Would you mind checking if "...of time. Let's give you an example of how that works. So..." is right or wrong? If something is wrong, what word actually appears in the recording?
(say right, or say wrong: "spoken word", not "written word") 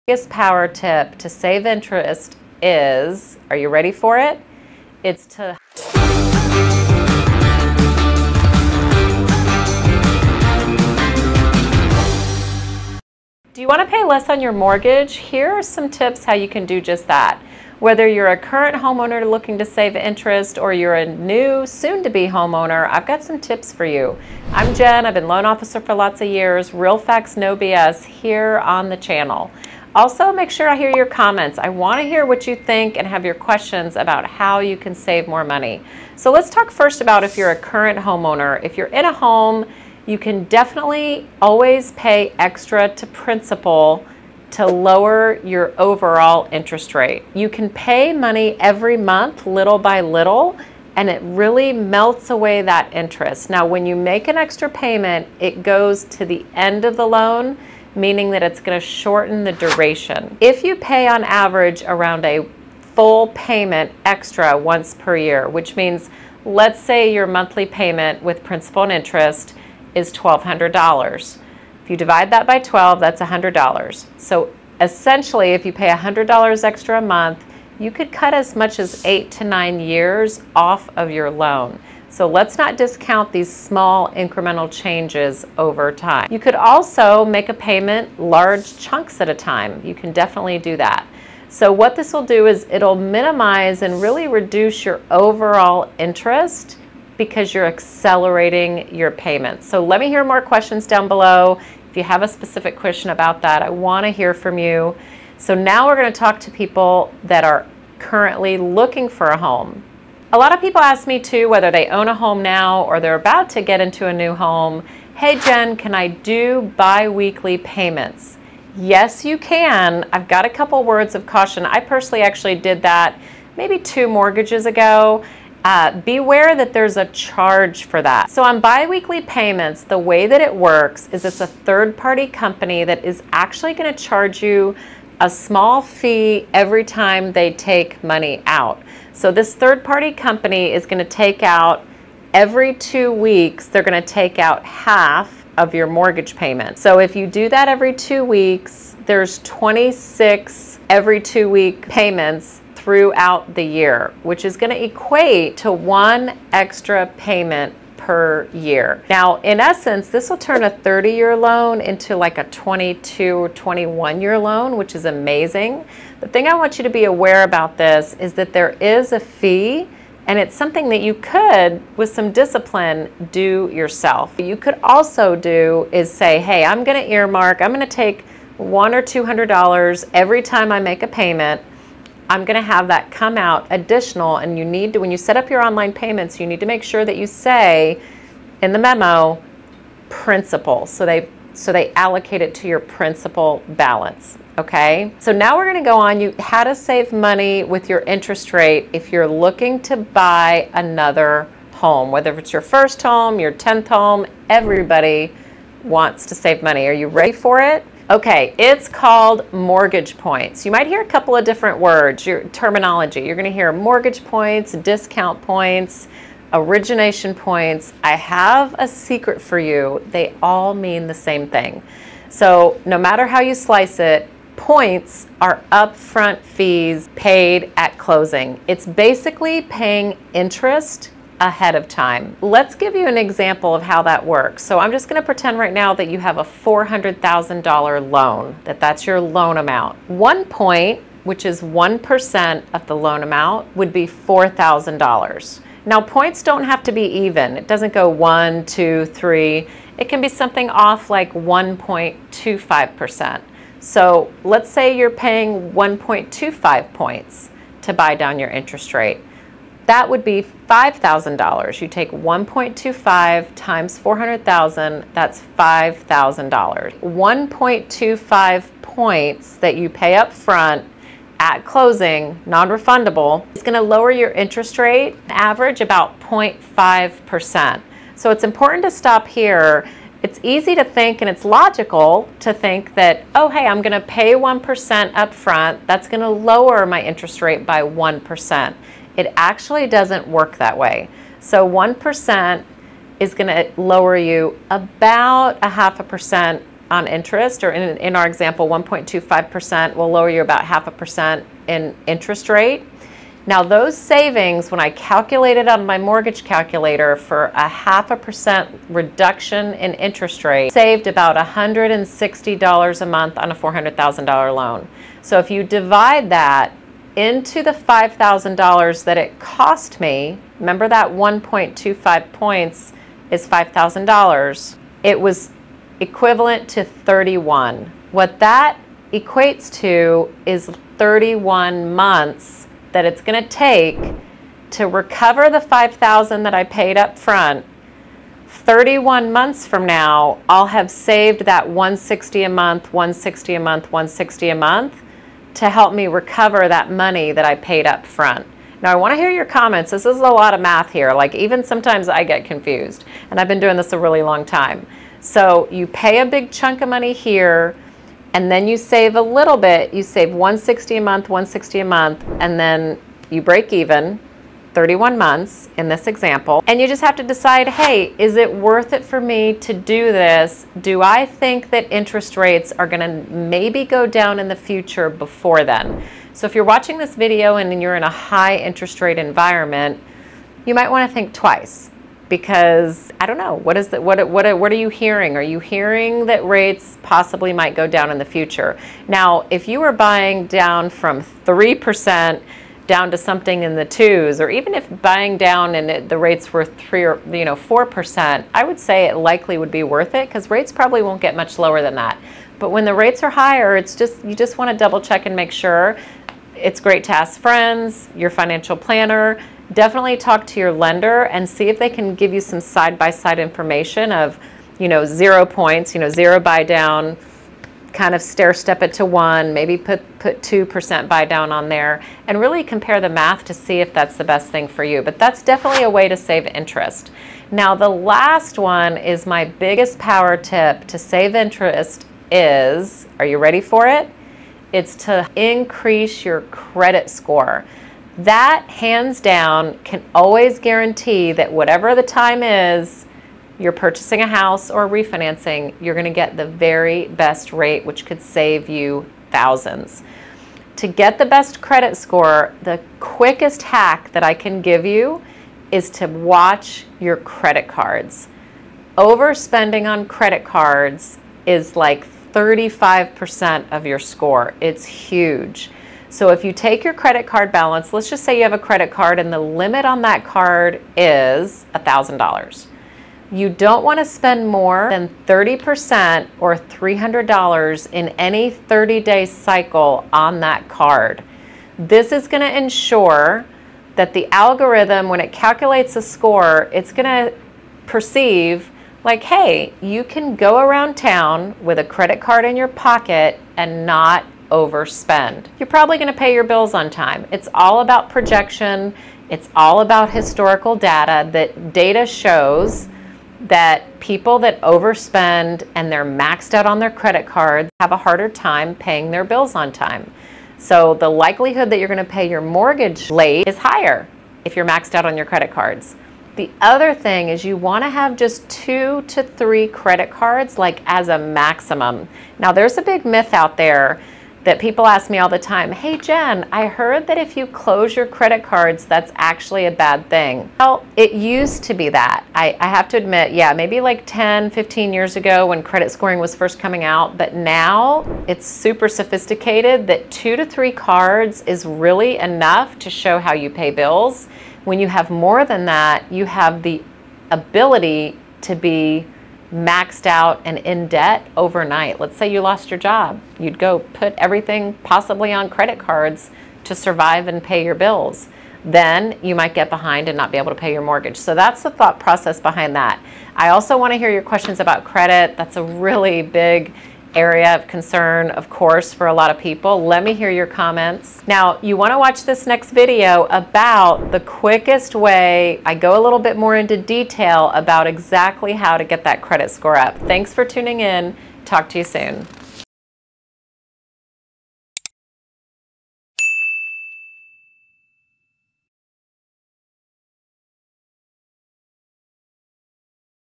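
right.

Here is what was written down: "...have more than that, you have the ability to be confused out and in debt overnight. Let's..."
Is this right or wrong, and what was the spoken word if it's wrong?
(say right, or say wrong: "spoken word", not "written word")
wrong: "maxed", not "confused".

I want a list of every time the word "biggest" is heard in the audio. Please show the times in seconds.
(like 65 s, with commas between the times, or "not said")
0 s, 429 s.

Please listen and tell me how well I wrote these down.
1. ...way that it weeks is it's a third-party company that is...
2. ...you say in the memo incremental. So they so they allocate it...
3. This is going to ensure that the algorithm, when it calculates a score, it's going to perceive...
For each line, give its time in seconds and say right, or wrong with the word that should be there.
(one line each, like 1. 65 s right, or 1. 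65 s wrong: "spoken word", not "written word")
1. 129 s wrong: "works", not "weeks"
2. 187 s wrong: "principal", not "incremental"
3. 481 s right.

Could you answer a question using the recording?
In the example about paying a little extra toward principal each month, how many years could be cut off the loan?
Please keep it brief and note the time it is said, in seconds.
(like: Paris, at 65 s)
8 to 9 years, at 79 s.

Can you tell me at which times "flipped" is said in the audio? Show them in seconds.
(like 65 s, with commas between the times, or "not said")
not said.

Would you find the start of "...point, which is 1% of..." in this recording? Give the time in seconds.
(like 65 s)
240 s.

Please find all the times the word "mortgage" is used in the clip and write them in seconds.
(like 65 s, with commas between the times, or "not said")
14 s, 124 s, 145 s, 209 s, 213 s, 305 s, 512 s, 560 s.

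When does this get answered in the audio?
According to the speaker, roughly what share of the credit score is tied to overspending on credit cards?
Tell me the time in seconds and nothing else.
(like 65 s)
462 s.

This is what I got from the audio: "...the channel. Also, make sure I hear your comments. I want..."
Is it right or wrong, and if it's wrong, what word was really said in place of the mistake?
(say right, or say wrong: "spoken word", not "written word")
right.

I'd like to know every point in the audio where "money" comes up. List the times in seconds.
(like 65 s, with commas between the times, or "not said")
35 s, 48 s, 138 s, 197 s, 206 s, 346 s, 356 s.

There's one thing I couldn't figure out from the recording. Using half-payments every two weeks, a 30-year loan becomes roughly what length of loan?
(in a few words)
22 or 21 years.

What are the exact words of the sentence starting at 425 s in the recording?
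But that's definitely a way to save interest.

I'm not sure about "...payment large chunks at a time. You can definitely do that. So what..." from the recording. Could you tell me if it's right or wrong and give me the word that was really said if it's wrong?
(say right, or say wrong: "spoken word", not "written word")
right.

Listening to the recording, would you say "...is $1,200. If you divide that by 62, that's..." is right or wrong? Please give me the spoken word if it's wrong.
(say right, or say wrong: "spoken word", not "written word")
wrong: "12", not "62".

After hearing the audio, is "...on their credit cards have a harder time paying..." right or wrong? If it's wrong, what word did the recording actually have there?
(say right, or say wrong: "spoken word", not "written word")
right.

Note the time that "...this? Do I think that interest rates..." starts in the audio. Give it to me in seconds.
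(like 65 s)
370 s.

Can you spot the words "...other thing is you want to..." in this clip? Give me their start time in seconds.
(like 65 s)
516 s.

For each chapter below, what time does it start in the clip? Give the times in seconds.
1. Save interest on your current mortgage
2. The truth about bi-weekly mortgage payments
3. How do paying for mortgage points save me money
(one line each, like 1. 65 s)
1. 60 s
2. 180 s
3. 300 s.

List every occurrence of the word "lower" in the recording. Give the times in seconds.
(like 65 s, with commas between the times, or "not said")
44 s, 273 s, 286 s, 293 s, 300 s, 401 s.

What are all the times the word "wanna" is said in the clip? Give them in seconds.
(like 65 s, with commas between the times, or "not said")
103 s, 380 s.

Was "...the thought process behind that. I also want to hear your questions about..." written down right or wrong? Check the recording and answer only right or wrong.
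right.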